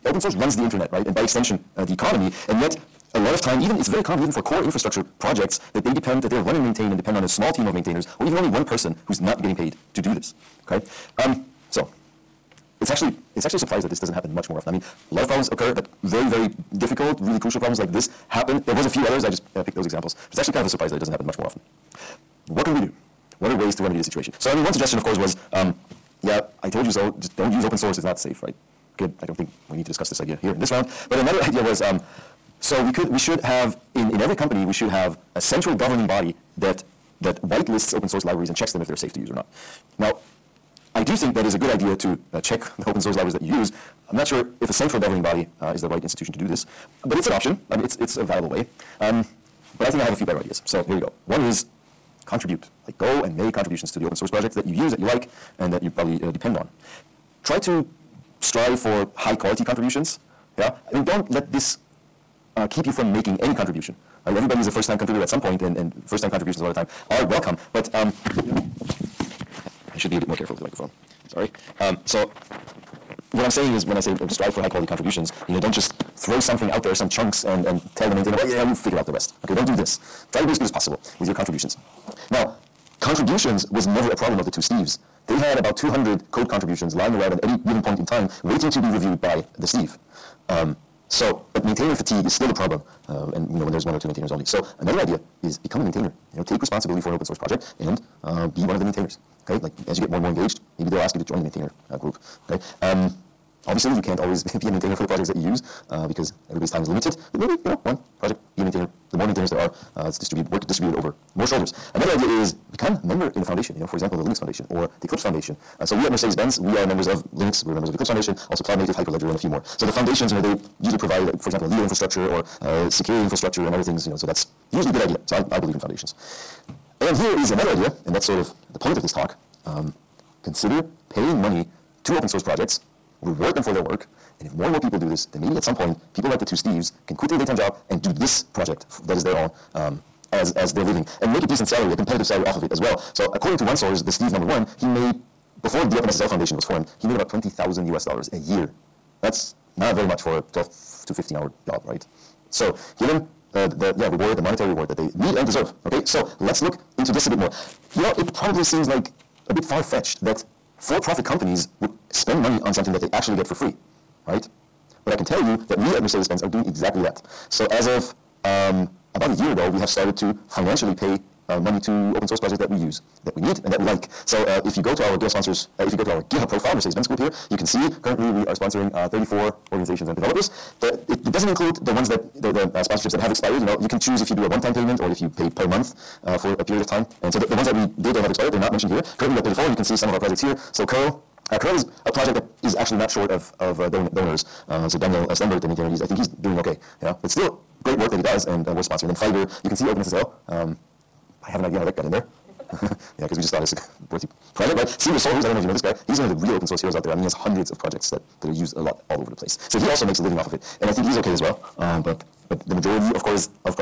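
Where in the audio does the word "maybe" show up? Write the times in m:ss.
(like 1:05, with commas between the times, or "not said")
1:40, 1:47, 2:15.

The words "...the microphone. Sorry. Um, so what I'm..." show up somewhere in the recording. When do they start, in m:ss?
1:10.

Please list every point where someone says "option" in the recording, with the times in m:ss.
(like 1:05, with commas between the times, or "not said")
0:47.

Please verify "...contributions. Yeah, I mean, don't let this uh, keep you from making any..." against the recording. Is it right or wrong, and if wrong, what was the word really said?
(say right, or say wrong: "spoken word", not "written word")
right.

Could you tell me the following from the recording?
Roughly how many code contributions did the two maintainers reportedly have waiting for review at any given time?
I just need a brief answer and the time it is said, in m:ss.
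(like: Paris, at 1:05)
200, at 1:25.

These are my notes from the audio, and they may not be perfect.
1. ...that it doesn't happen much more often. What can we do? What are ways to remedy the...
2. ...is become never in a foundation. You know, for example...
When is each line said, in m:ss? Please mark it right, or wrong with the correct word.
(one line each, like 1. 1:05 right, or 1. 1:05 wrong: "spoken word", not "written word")
1. 0:20 right
2. 1:52 wrong: "member", not "never".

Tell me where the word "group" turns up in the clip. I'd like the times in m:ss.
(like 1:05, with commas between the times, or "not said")
1:41, 2:57.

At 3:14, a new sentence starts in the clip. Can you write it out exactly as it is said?
Uh, so Daniel uh, Stenberg, the maintainer, he's, I think he's doing okay.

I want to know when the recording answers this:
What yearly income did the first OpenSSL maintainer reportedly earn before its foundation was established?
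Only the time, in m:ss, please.
2:27.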